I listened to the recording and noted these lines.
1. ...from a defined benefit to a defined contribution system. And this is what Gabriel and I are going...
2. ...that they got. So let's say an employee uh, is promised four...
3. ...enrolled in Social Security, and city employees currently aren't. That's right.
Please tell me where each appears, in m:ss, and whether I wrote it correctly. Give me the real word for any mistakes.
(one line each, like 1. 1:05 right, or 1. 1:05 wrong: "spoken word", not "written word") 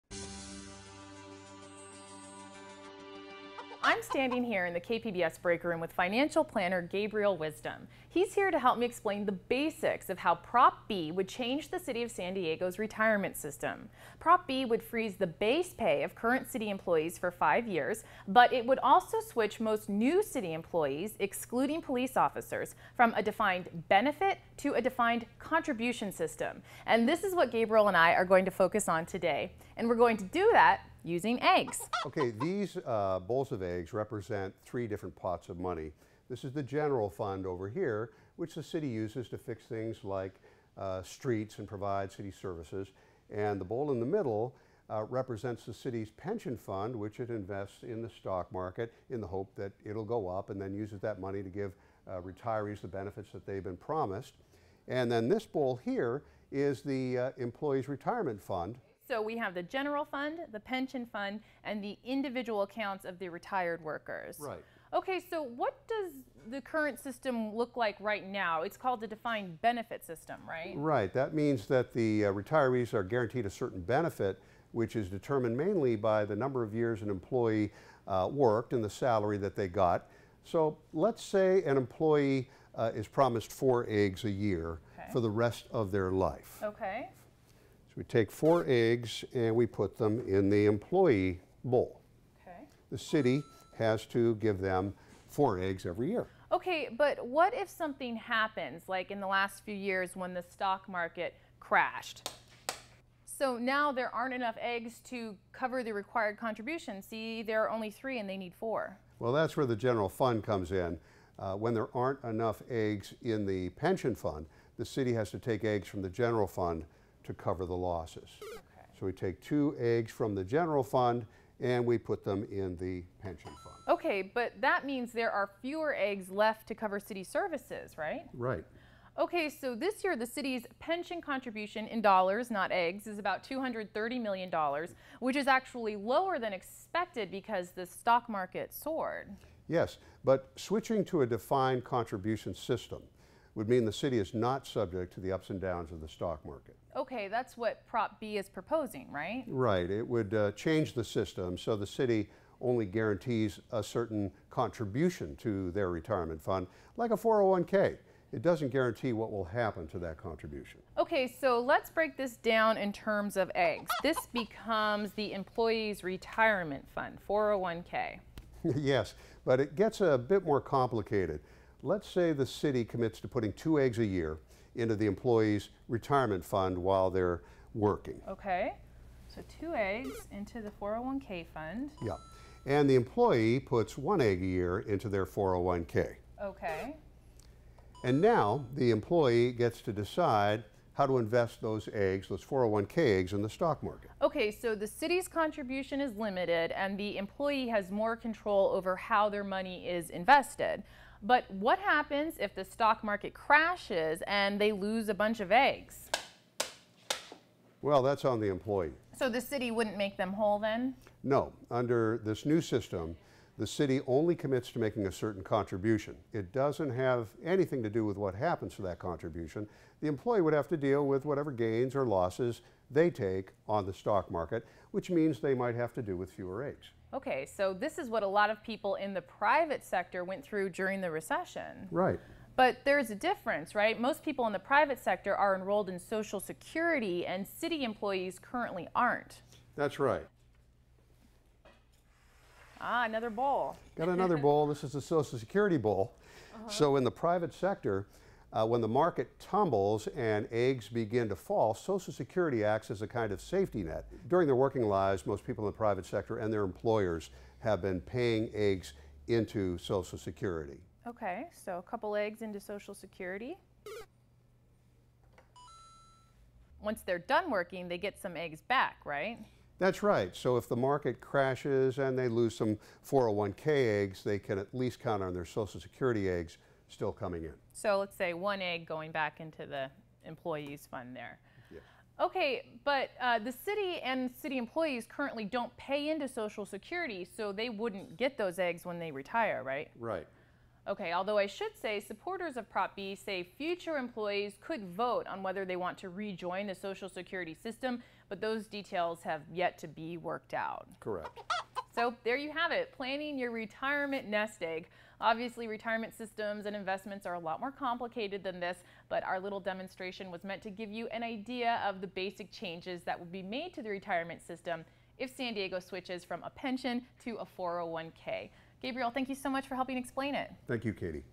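1. 0:22 right
2. 1:19 right
3. 3:55 right.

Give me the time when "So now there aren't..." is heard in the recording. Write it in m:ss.
1:43.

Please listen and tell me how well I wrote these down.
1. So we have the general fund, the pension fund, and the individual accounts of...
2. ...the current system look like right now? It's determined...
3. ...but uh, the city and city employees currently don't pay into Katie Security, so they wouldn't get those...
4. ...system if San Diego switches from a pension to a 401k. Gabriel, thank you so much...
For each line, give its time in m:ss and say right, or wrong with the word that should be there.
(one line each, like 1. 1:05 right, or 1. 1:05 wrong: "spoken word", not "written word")
1. 0:59 right
2. 1:06 wrong: "called", not "determined"
3. 4:42 wrong: "Social", not "Katie"
4. 5:14 right.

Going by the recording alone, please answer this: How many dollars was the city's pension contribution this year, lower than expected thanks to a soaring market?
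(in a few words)
$230 million.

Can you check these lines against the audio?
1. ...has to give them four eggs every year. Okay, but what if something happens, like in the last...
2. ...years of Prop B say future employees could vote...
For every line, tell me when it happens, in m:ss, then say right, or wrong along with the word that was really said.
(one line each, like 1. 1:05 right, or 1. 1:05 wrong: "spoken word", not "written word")
1. 1:33 right
2. 4:51 wrong: "supporters", not "years".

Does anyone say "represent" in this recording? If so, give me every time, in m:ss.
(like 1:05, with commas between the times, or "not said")
0:33, 0:45.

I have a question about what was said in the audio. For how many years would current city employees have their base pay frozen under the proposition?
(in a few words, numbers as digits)
5.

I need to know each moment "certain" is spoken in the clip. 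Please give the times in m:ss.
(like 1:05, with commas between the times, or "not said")
1:13, 2:33, 3:35.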